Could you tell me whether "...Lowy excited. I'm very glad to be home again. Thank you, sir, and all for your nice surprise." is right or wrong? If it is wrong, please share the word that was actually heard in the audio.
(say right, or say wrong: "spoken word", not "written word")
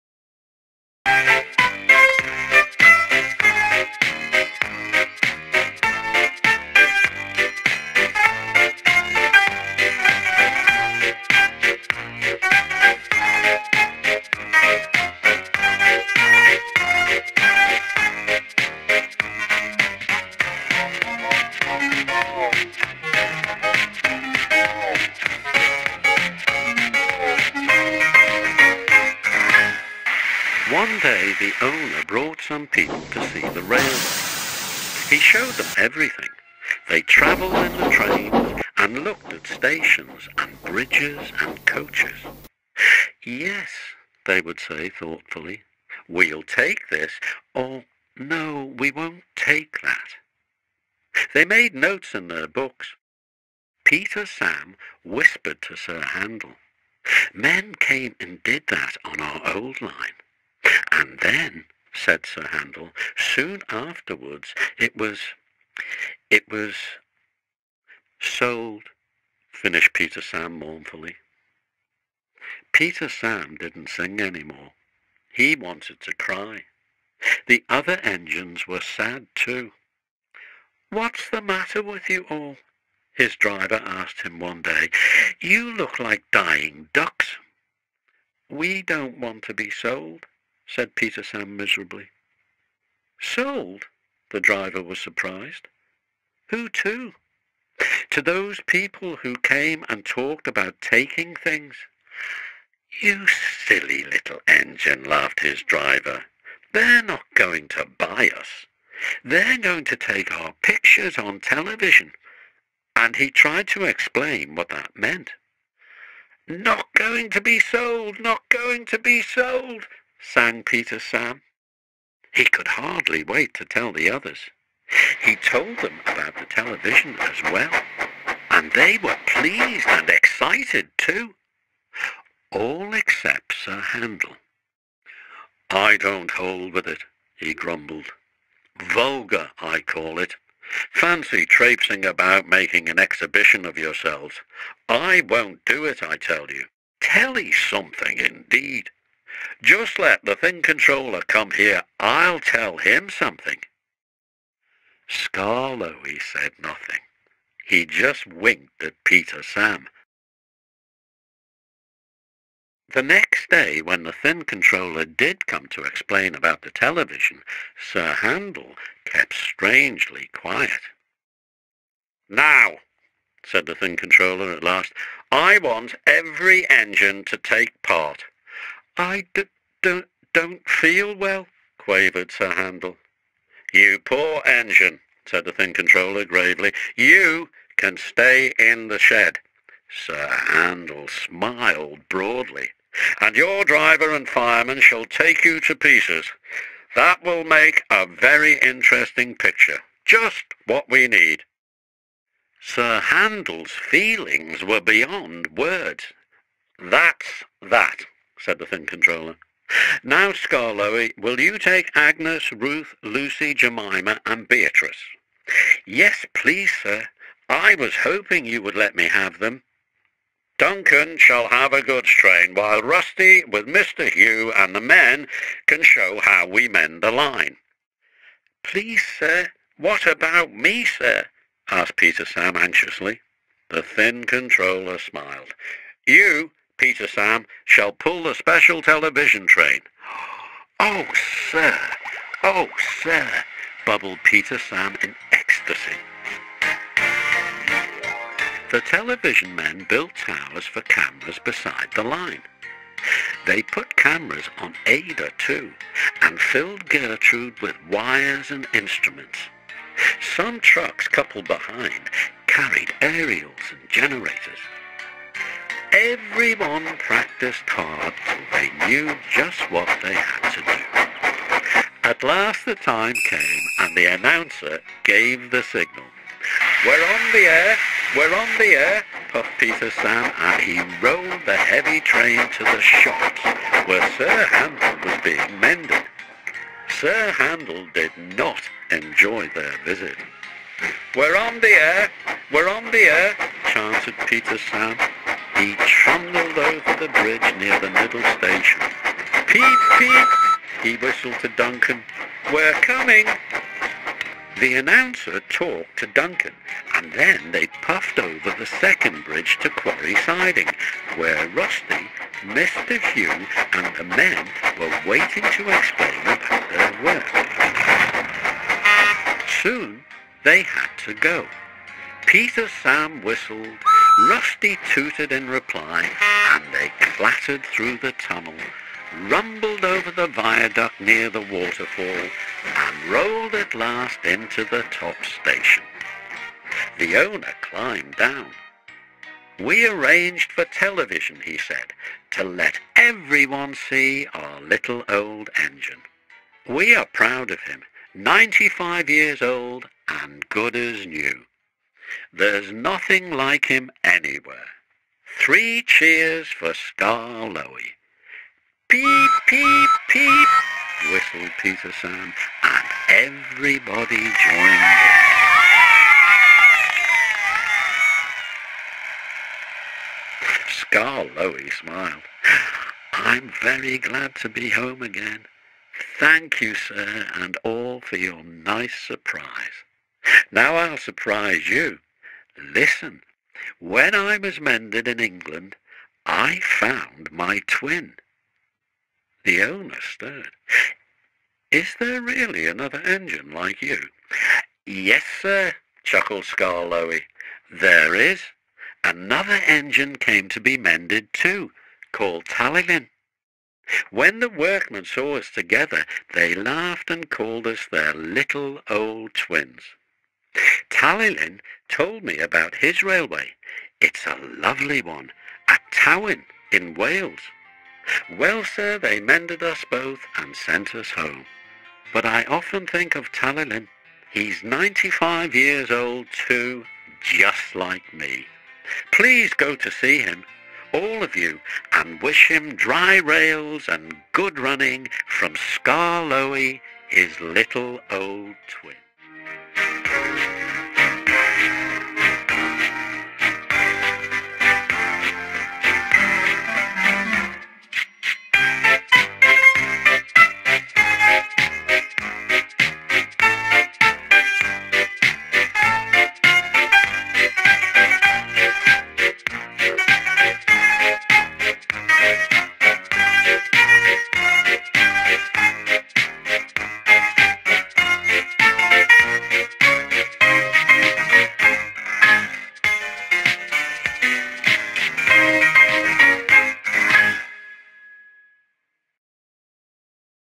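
wrong: "smiled", not "excited".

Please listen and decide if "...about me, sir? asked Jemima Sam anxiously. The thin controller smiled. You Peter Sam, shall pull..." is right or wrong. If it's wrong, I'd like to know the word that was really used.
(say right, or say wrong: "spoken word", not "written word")
wrong: "Peter", not "Jemima".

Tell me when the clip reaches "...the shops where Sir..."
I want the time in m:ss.
4:42.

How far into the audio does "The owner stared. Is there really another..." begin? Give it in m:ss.
6:29.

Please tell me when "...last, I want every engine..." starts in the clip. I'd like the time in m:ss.
2:54.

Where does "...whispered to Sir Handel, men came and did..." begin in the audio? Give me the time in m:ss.
0:55.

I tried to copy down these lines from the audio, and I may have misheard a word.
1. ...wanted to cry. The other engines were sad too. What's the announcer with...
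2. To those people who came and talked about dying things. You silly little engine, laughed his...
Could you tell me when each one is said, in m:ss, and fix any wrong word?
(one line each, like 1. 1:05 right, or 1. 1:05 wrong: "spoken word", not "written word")
1. 1:15 wrong: "matter", not "announcer"
2. 1:38 wrong: "taking", not "dying".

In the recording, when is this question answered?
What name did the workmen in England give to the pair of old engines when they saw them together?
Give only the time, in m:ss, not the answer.
6:48.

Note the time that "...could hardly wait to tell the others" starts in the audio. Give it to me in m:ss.
2:02.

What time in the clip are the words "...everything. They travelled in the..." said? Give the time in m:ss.
0:35.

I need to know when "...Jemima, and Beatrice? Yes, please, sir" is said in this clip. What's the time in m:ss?
3:33.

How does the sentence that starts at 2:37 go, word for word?
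He just winked at Peter Sam.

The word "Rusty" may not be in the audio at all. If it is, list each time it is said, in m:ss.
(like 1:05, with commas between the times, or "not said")
3:42, 5:11, 5:24.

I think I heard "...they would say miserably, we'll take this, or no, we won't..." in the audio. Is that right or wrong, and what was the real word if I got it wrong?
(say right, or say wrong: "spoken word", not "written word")
wrong: "thoughtfully", not "miserably".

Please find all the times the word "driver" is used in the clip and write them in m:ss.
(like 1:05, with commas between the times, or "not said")
1:23, 1:34, 1:45, 3:13.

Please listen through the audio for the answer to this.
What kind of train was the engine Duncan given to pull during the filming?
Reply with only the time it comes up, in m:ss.
3:41.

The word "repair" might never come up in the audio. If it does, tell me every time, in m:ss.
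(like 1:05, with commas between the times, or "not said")
not said.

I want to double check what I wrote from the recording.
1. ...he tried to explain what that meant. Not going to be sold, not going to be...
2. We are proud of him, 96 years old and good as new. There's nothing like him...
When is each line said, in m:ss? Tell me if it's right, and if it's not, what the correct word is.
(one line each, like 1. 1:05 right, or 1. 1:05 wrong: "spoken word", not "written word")
1. 1:53 right
2. 5:46 wrong: "95", not "96".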